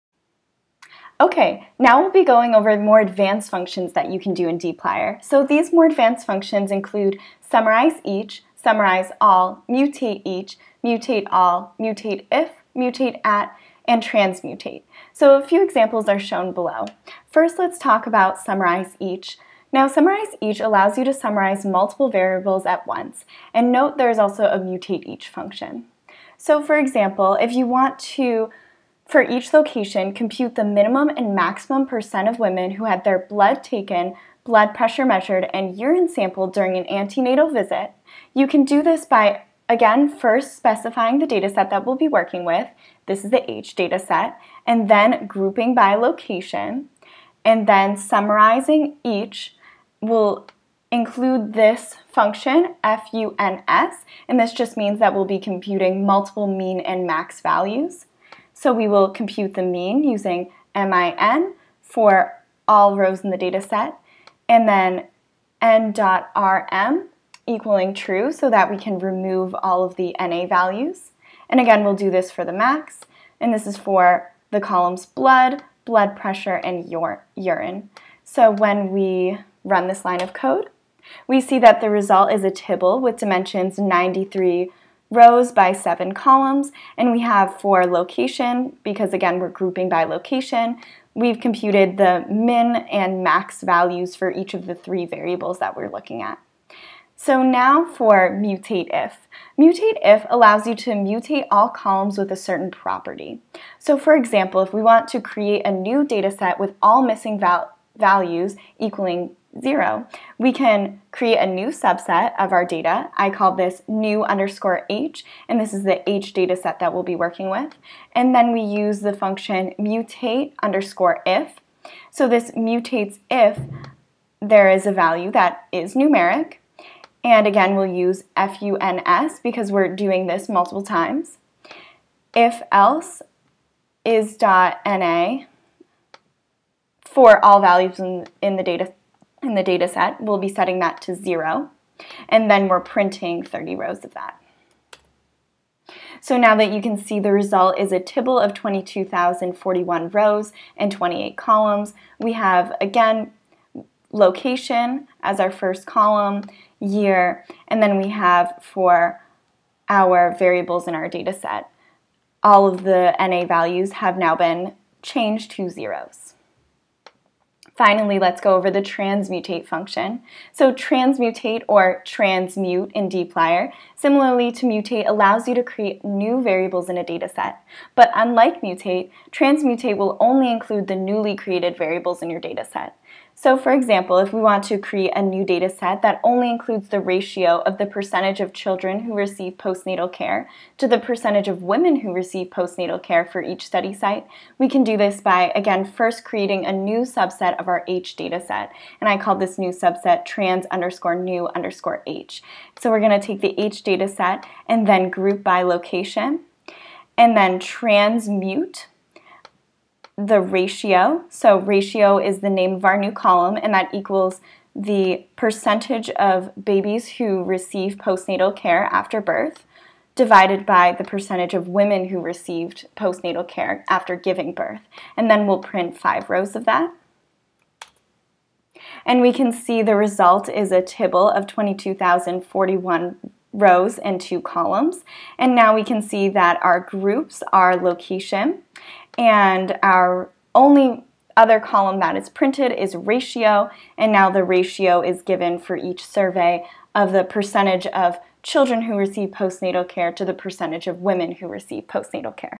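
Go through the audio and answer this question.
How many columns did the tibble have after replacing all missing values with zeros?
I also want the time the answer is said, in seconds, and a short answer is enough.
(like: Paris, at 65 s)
28, at 150 s.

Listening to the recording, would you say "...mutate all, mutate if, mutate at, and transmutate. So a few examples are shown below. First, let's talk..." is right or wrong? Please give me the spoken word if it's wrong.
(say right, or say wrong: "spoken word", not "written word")
right.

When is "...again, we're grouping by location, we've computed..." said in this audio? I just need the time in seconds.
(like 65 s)
89 s.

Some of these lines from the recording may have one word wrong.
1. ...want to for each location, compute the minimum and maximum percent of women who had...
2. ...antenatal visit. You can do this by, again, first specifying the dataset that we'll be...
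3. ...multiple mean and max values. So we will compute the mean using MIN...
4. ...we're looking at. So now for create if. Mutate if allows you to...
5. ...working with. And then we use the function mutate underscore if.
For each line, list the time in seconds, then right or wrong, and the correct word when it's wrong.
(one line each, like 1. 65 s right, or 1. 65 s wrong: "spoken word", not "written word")
1. 27 s right
2. 36 s right
3. 56 s right
4. 95 s wrong: "mutate", not "create"
5. 117 s right.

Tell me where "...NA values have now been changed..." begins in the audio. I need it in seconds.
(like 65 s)
163 s.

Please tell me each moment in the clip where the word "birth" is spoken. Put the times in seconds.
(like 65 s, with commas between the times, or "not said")
219 s, 224 s.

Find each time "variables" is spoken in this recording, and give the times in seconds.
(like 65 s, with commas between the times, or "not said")
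22 s, 95 s, 160 s, 176 s, 181 s.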